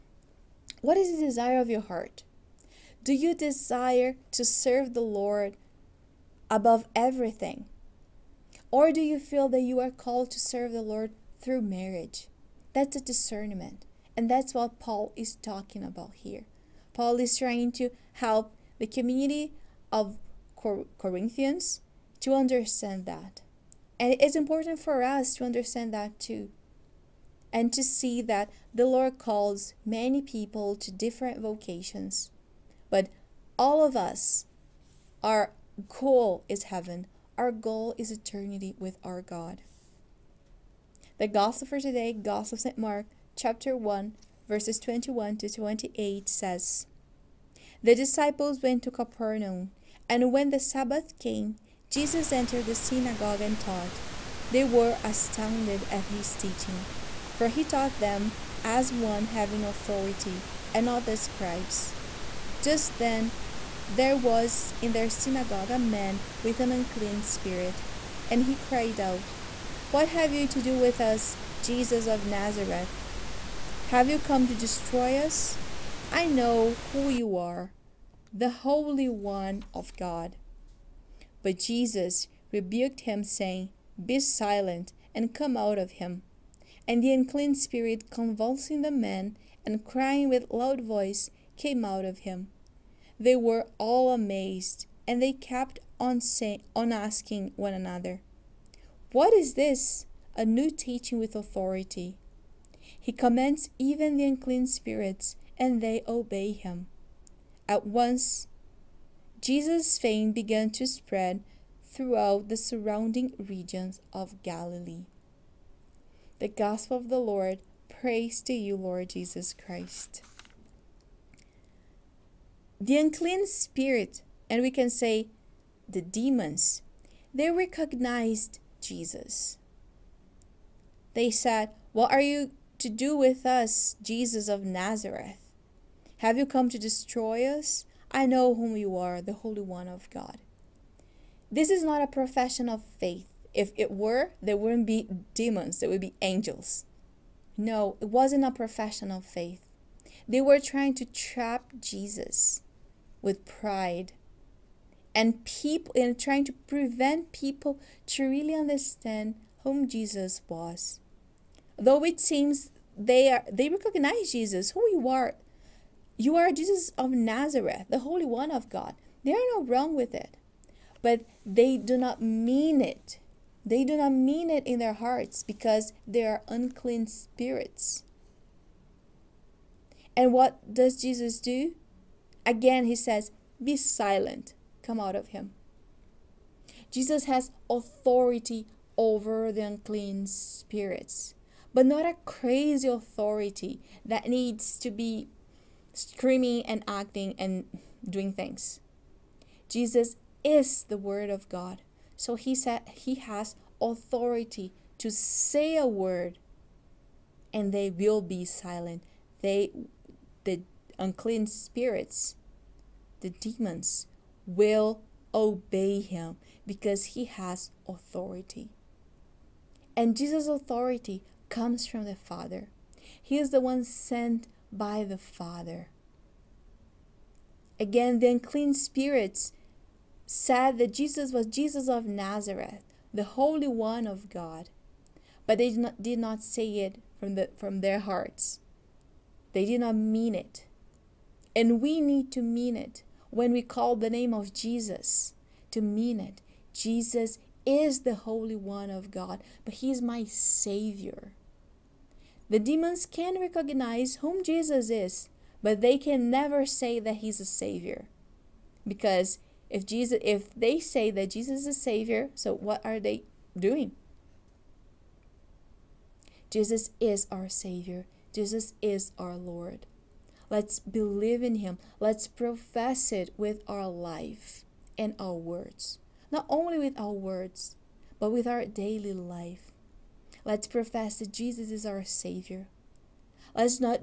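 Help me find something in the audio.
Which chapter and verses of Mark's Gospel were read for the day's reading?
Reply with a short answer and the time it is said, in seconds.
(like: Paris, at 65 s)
Chapter 1, verses 21 to 28, at 43 s.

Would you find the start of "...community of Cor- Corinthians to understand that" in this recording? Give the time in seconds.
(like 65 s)
18 s.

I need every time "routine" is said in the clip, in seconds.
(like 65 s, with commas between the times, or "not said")
not said.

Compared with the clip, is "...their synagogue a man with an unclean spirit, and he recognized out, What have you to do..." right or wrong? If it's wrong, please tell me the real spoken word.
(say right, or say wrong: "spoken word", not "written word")
wrong: "cried", not "recognized".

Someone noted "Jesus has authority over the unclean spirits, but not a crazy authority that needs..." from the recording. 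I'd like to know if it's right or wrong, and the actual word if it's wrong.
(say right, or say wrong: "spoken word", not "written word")
right.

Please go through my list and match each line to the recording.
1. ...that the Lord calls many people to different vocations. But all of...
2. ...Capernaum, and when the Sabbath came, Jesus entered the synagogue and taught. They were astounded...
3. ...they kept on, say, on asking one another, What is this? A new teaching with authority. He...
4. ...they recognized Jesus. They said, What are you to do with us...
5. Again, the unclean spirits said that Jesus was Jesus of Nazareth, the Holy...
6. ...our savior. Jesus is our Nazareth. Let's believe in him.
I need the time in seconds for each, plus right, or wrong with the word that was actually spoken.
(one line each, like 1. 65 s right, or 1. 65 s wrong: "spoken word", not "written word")
1. 28 s right
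2. 48 s right
3. 95 s right
4. 127 s right
5. 227 s right
6. 267 s wrong: "Lord", not "Nazareth".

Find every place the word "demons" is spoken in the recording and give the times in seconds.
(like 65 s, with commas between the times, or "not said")
126 s, 145 s, 213 s, 252 s.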